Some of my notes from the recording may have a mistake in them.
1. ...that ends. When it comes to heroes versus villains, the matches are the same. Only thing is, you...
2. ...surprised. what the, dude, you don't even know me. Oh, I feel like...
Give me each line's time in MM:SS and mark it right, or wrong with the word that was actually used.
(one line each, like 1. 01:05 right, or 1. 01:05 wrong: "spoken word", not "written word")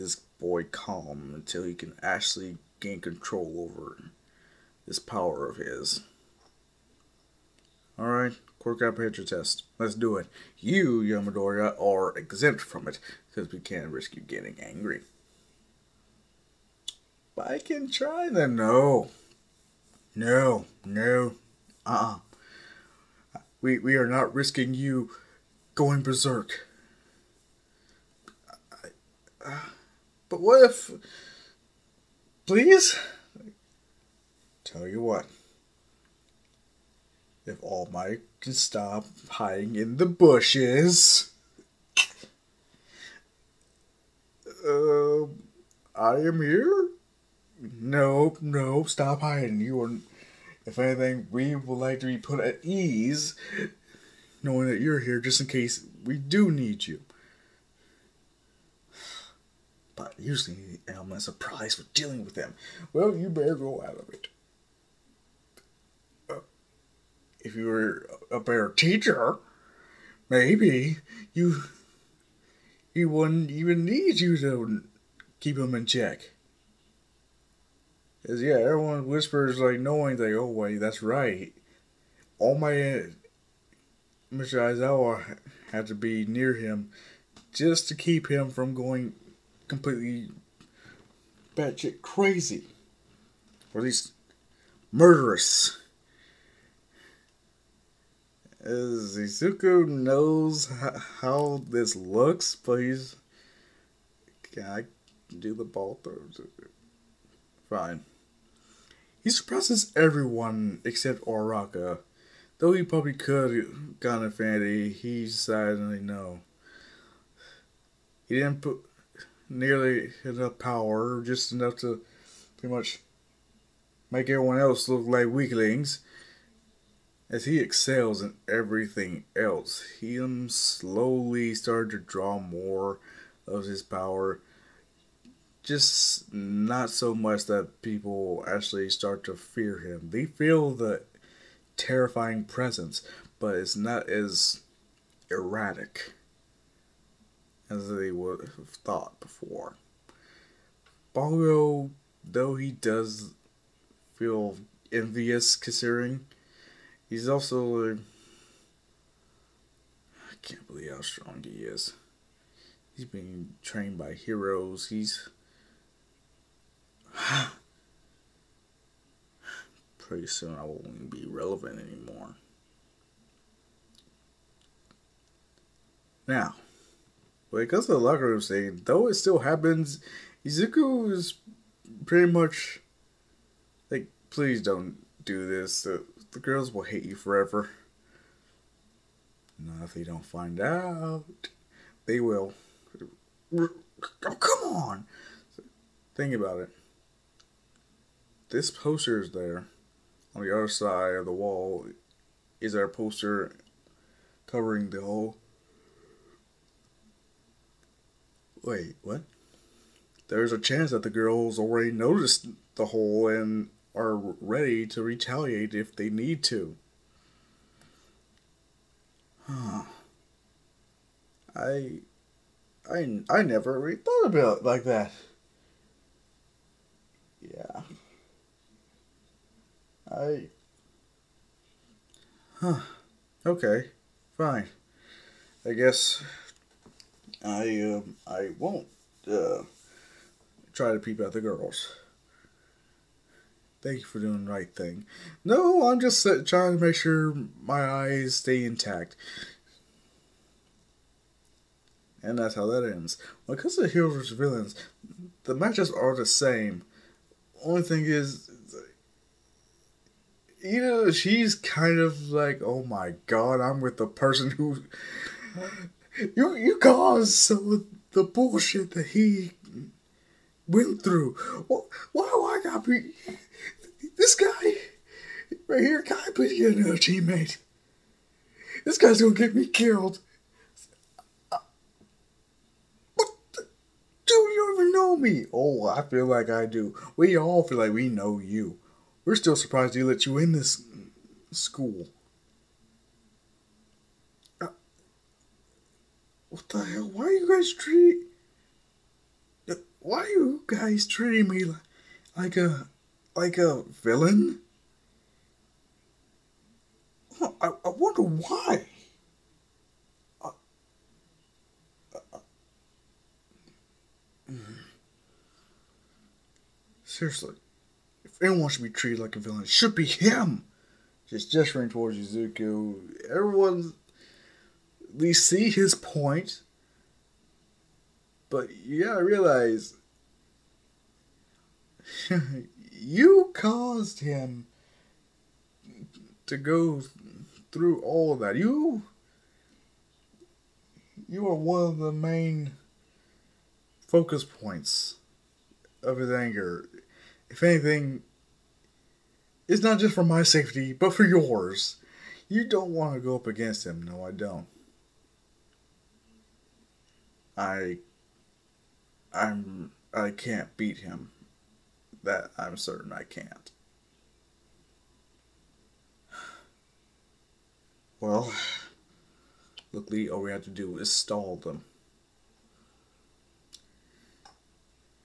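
1. 04:12 right
2. 04:39 wrong: "killed", not "surprised".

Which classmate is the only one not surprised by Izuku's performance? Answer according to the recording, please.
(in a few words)
Uraraka.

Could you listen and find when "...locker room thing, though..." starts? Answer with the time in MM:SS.
02:57.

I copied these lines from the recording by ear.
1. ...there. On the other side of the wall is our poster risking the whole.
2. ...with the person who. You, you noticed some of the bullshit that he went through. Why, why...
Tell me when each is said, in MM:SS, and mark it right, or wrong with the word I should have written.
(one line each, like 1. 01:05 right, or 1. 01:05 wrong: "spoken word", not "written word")
1. 03:19 wrong: "covering", not "risking"
2. 04:23 wrong: "caused", not "noticed".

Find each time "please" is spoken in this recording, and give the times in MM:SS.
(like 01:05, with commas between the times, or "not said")
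00:32, 03:04, 04:36.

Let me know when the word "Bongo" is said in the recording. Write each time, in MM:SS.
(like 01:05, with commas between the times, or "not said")
02:31.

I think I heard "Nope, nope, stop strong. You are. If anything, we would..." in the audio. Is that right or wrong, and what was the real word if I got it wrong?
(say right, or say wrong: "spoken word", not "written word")
wrong: "hiding", not "strong".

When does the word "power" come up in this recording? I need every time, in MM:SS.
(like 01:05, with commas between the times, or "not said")
00:04, 02:00, 02:13.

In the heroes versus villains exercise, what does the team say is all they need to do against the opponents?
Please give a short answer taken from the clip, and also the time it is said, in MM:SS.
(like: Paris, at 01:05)
Stall them, at 06:11.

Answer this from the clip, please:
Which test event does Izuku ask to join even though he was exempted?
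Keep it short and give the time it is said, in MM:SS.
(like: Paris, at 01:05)
Ball throws, at 01:45.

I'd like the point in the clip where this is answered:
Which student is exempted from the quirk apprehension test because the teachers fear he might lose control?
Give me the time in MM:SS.
00:11.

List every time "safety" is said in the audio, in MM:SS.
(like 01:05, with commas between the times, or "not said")
05:50.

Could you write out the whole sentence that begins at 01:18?
Cause yeah, everyone whispers like knowing like, oh wait, that's right.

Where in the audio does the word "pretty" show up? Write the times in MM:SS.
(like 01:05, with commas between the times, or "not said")
02:02, 02:49, 03:02.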